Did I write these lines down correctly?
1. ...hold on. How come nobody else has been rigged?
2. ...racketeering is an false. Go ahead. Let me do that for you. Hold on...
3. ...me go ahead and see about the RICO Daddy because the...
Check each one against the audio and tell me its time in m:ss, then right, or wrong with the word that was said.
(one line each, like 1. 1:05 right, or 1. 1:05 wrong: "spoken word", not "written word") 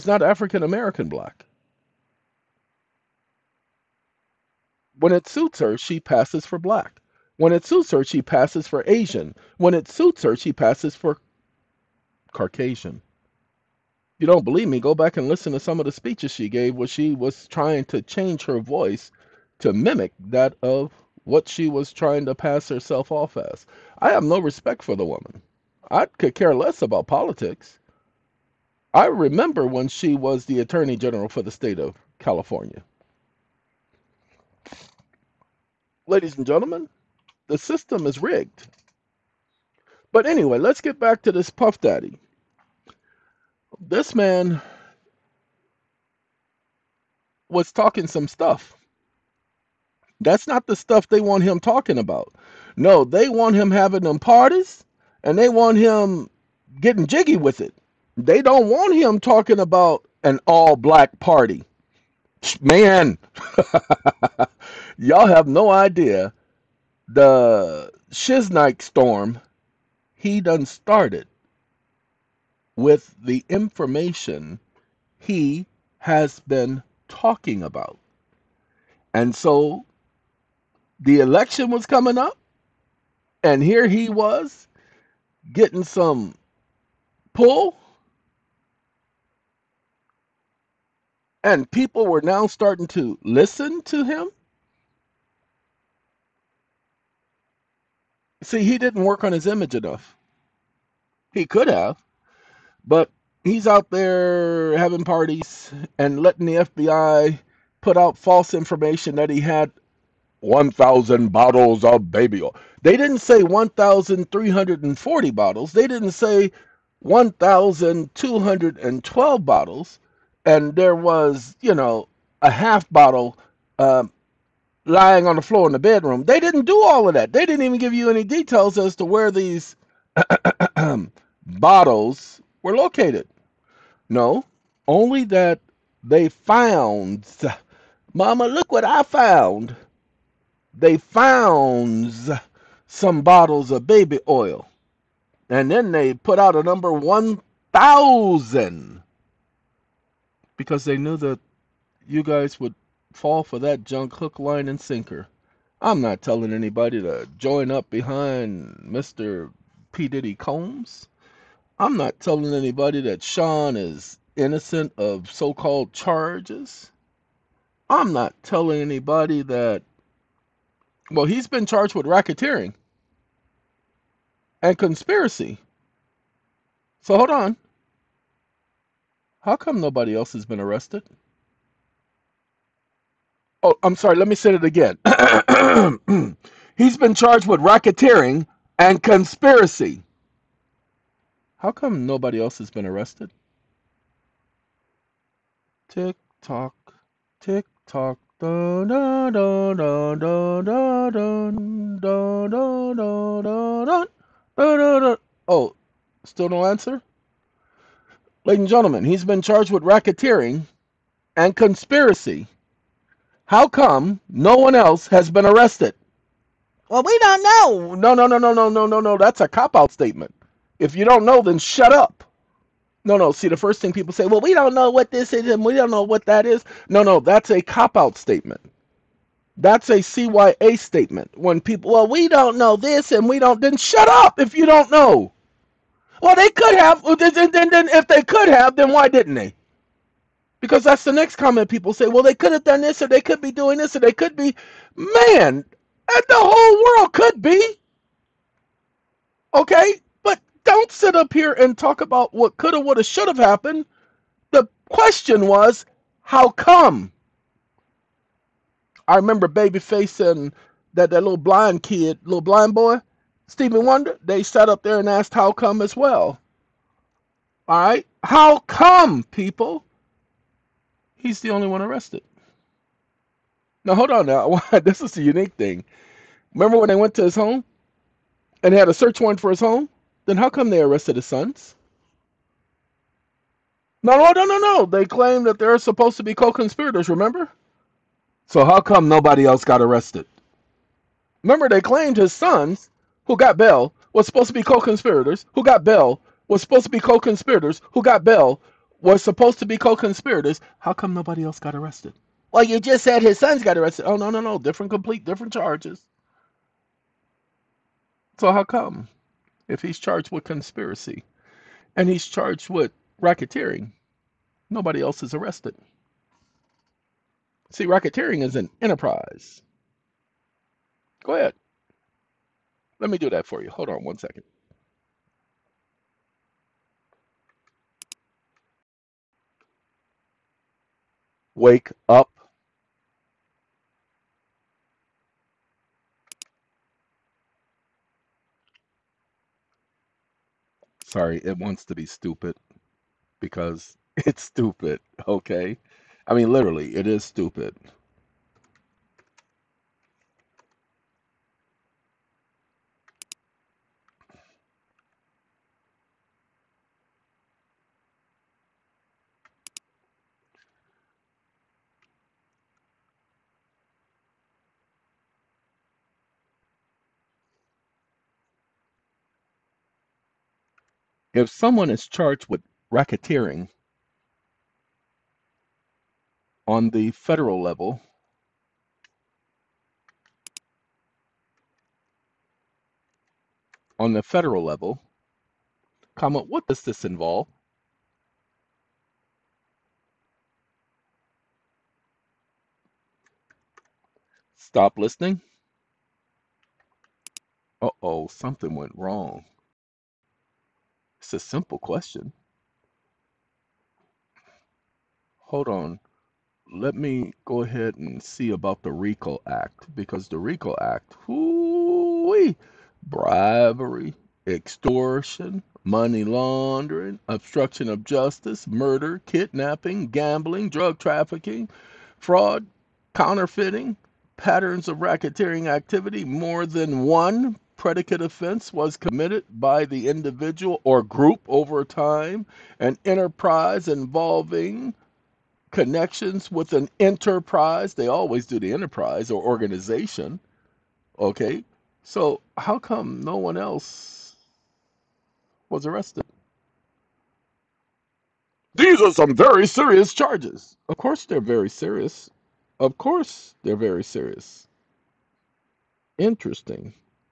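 1. 2:57 wrong: "arrested", not "rigged"
2. 5:17 wrong: "enterprise", not "false"
3. 6:46 wrong: "Act", not "Daddy".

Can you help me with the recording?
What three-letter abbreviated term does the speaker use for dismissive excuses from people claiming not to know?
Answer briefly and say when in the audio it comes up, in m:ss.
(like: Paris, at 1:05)
CYA statement, at 3:49.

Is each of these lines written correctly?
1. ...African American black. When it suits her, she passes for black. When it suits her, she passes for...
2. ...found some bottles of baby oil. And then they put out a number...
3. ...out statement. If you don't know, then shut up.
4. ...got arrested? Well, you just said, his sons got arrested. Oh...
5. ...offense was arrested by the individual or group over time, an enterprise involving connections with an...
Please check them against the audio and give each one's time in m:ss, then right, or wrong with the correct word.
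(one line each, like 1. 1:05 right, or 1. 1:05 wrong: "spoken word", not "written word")
1. 0:00 right
2. 2:20 right
3. 3:39 right
4. 5:01 right
5. 7:08 wrong: "committed", not "arrested".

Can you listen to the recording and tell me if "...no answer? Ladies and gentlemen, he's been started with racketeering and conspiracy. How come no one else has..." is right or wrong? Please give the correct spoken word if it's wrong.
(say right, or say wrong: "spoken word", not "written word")
wrong: "charged", not "started".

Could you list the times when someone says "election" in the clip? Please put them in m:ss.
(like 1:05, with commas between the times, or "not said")
1:21.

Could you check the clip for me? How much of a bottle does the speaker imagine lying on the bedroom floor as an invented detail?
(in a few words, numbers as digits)
Half bottle.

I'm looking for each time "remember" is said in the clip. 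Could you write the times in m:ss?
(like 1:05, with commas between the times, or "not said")
0:29, 4:19, 4:36, 4:47, 4:51.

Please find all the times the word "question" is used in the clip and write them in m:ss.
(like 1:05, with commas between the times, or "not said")
4:14, 6:41.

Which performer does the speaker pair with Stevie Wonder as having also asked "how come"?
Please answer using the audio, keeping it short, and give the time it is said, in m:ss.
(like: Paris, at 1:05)
Babyface, at 4:19.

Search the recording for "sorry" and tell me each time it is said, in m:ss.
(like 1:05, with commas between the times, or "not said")
3:03, 5:41.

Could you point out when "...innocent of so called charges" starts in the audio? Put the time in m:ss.
2:44.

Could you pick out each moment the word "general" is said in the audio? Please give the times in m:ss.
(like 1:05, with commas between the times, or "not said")
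0:30.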